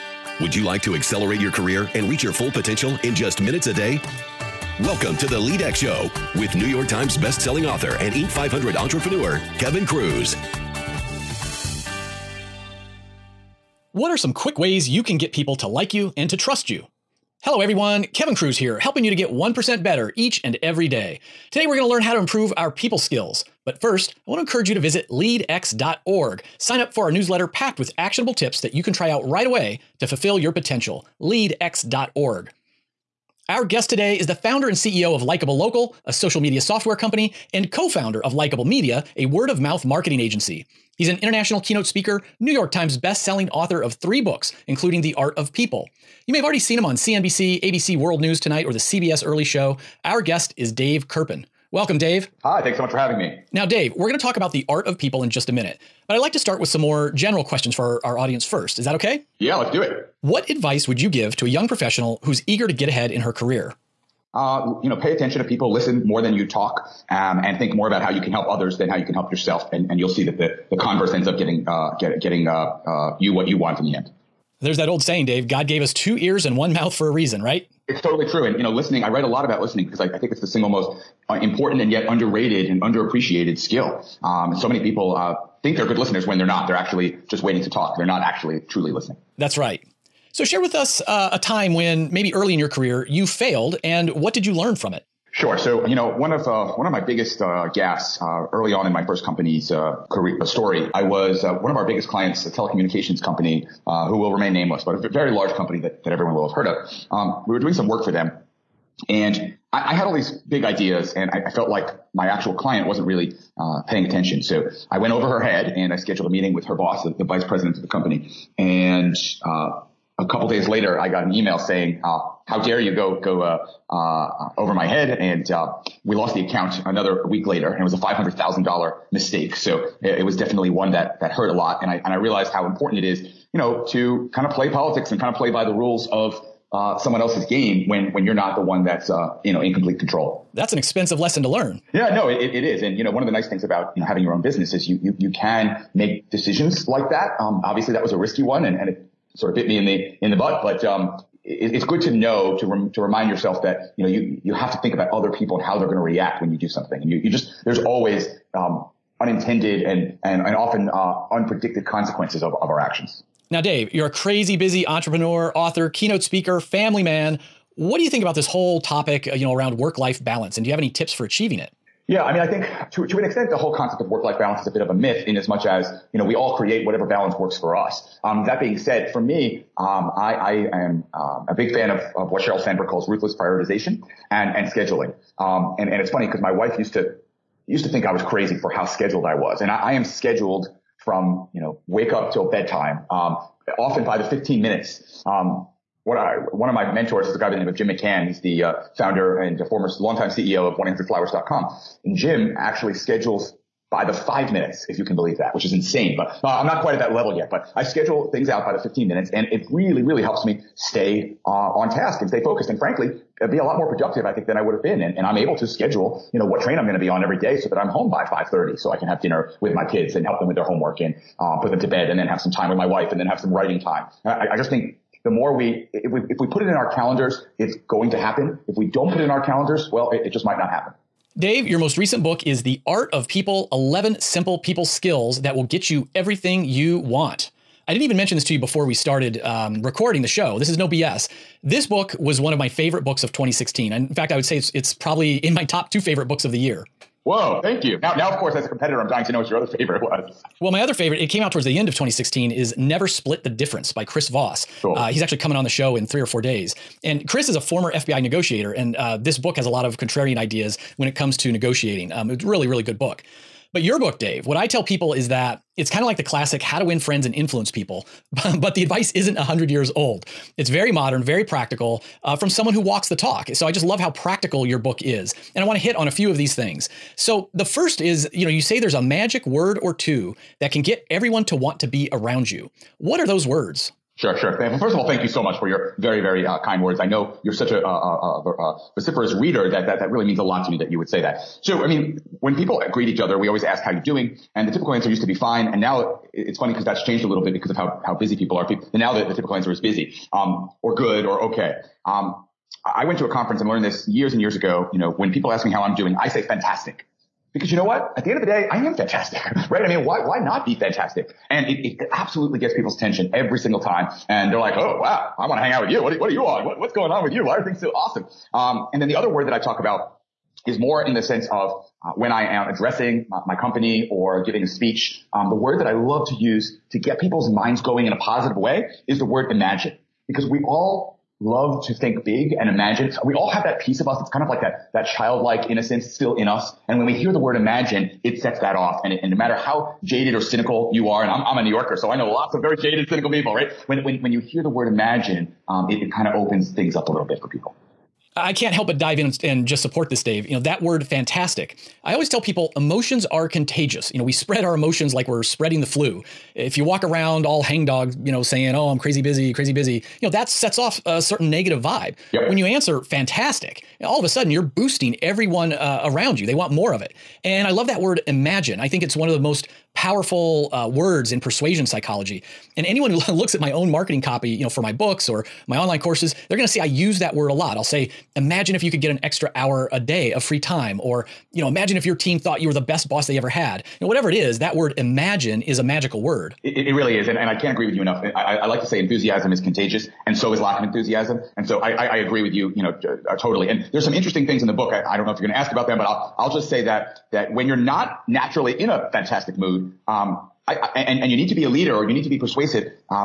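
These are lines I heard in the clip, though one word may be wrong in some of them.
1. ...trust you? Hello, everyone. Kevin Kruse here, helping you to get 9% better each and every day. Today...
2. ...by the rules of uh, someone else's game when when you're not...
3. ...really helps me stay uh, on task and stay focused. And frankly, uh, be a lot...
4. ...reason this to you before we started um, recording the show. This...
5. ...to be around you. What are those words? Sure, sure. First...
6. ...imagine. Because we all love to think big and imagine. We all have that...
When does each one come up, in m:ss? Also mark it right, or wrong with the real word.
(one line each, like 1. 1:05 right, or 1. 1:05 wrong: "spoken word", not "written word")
1. 0:16 wrong: "1", not "9"
2. 2:15 right
3. 3:30 right
4. 3:58 wrong: "mention", not "reason"
5. 4:41 right
6. 5:29 right.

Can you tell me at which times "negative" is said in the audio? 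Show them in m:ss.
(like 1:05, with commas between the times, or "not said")
6:01.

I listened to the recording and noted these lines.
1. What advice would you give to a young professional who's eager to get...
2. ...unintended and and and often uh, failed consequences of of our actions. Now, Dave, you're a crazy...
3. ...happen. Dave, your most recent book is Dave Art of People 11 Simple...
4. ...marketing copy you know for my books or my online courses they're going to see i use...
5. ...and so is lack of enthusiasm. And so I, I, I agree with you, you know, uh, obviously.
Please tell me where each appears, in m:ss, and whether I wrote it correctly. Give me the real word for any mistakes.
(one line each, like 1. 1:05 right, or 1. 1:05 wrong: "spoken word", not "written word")
1. 1:00 right
2. 2:39 wrong: "unpredicted", not "failed"
3. 3:50 wrong: "The", not "Dave"
4. 6:13 right
5. 6:30 wrong: "totally", not "obviously".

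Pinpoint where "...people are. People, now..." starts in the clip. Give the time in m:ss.
4:58.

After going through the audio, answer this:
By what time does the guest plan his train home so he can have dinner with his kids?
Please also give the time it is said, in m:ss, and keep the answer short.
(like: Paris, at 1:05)
5:30, at 3:38.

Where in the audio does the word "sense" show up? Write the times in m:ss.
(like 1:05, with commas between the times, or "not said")
5:21.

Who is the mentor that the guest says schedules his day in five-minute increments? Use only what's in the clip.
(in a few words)
Jim McCann.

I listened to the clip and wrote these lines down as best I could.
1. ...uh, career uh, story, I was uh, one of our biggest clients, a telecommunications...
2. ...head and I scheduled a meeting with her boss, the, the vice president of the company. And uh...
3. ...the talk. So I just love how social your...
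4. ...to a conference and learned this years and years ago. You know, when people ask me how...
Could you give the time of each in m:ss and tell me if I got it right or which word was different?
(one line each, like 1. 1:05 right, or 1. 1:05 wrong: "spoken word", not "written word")
1. 1:39 right
2. 1:55 right
3. 4:33 wrong: "practical", not "social"
4. 5:03 right.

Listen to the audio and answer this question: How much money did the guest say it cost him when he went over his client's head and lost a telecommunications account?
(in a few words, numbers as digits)
$500,000.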